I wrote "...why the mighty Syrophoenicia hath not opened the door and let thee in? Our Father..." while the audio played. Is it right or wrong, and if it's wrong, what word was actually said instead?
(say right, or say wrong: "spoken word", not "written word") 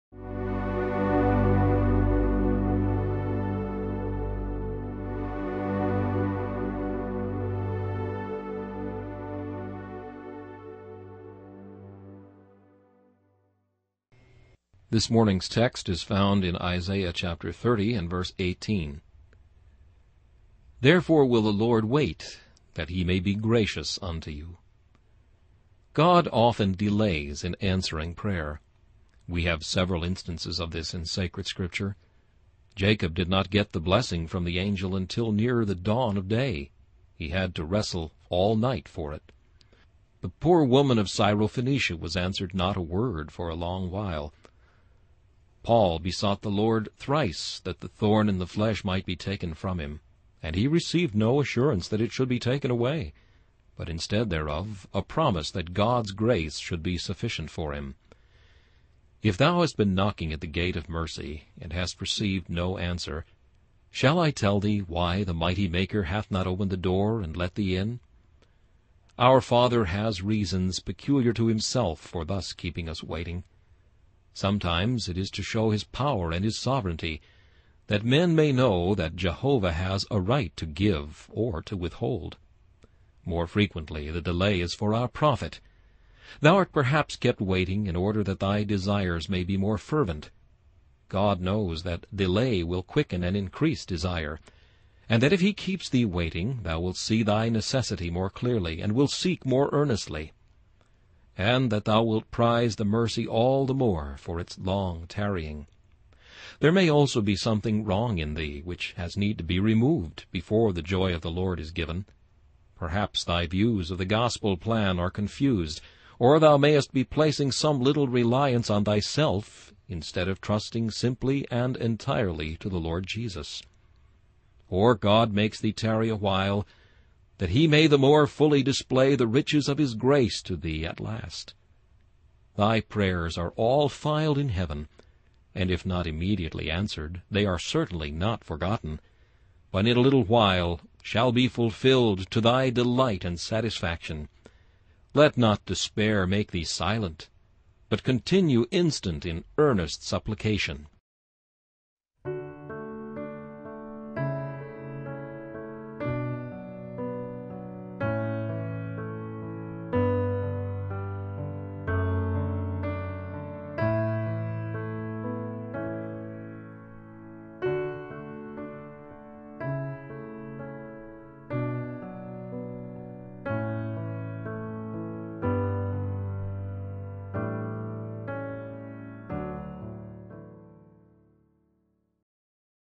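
wrong: "Maker", not "Syrophoenicia".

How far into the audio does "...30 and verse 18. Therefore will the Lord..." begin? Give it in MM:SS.
00:17.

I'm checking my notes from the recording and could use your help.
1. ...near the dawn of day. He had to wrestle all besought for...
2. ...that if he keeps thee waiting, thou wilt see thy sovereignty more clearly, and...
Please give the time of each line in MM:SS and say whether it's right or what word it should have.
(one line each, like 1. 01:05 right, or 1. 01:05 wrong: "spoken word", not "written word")
1. 00:35 wrong: "night", not "besought"
2. 01:35 wrong: "necessity", not "sovereignty".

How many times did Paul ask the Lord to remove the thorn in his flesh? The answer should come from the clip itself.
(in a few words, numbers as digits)
3.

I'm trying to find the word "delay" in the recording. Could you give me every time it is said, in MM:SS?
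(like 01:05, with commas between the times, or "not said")
00:26, 01:24, 01:32.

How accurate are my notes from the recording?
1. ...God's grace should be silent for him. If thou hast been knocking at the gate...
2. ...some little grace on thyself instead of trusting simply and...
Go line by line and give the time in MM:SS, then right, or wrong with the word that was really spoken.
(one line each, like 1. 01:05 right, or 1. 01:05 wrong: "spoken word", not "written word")
1. 00:55 wrong: "sufficient", not "silent"
2. 01:57 wrong: "reliance", not "grace".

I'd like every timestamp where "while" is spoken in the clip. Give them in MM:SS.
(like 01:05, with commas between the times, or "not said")
00:43, 02:06, 02:20.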